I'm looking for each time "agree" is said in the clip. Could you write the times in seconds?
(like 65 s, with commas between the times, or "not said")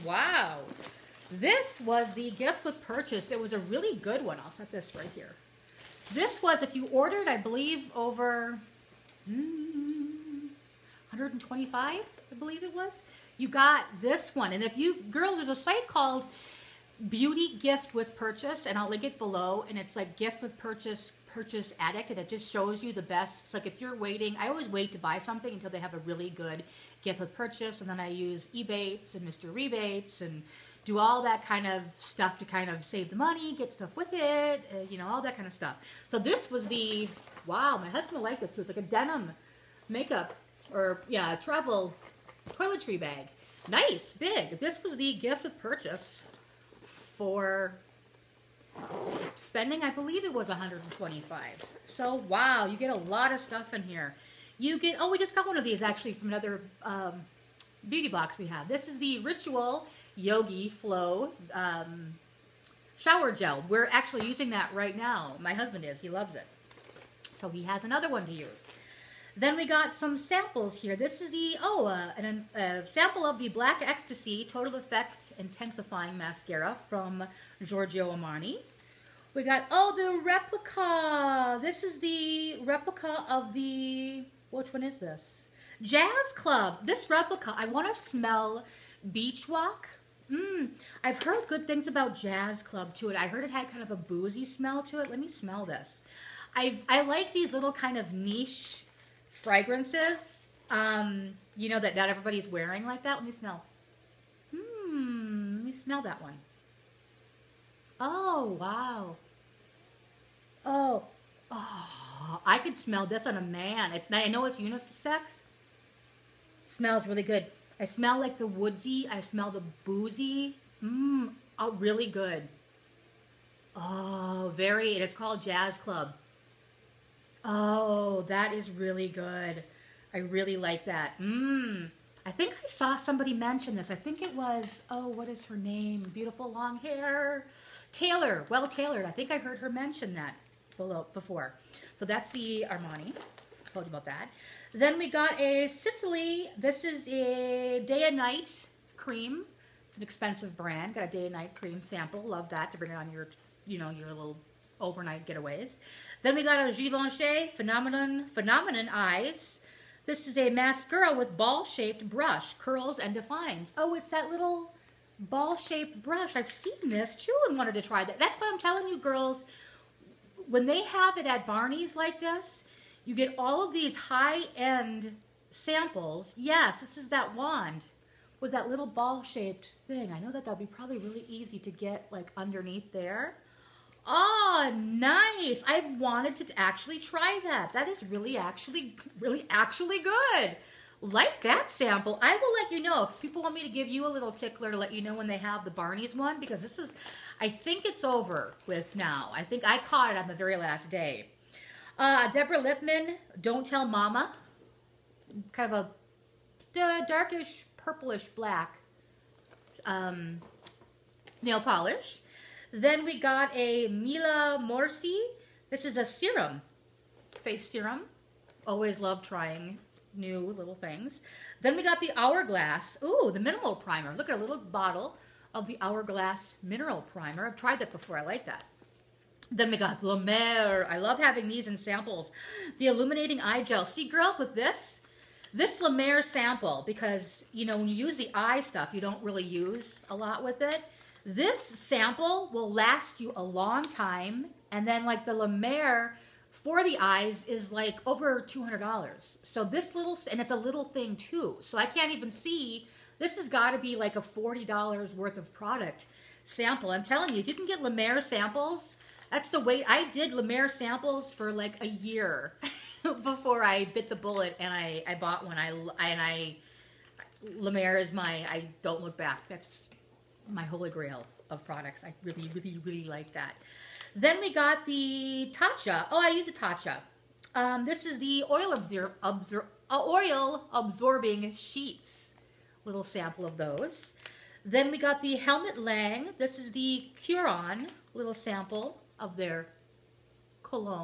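not said.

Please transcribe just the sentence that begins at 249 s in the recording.
So this little, and it's a little thing too.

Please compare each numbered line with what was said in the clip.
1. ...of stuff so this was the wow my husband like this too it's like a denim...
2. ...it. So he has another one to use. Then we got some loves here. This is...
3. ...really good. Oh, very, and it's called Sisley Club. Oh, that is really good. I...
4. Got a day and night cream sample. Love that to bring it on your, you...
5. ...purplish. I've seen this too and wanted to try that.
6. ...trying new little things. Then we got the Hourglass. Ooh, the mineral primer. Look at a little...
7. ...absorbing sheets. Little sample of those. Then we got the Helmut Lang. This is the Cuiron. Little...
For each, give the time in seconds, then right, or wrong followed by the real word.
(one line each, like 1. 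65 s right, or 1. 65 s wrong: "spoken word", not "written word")
1. 35 s right
2. 66 s wrong: "samples", not "loves"
3. 121 s wrong: "Jazz", not "Sisley"
4. 150 s right
5. 166 s wrong: "brush", not "purplish"
6. 219 s right
7. 280 s right.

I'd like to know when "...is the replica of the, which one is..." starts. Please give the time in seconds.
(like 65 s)
81 s.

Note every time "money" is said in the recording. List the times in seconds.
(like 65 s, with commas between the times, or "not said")
33 s.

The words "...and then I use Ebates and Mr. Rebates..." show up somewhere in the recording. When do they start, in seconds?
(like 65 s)
27 s.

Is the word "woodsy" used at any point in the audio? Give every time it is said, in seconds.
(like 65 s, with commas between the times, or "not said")
118 s.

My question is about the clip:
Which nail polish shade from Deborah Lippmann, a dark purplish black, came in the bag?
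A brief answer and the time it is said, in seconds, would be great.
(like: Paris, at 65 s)
Don't Tell Mama, at 203 s.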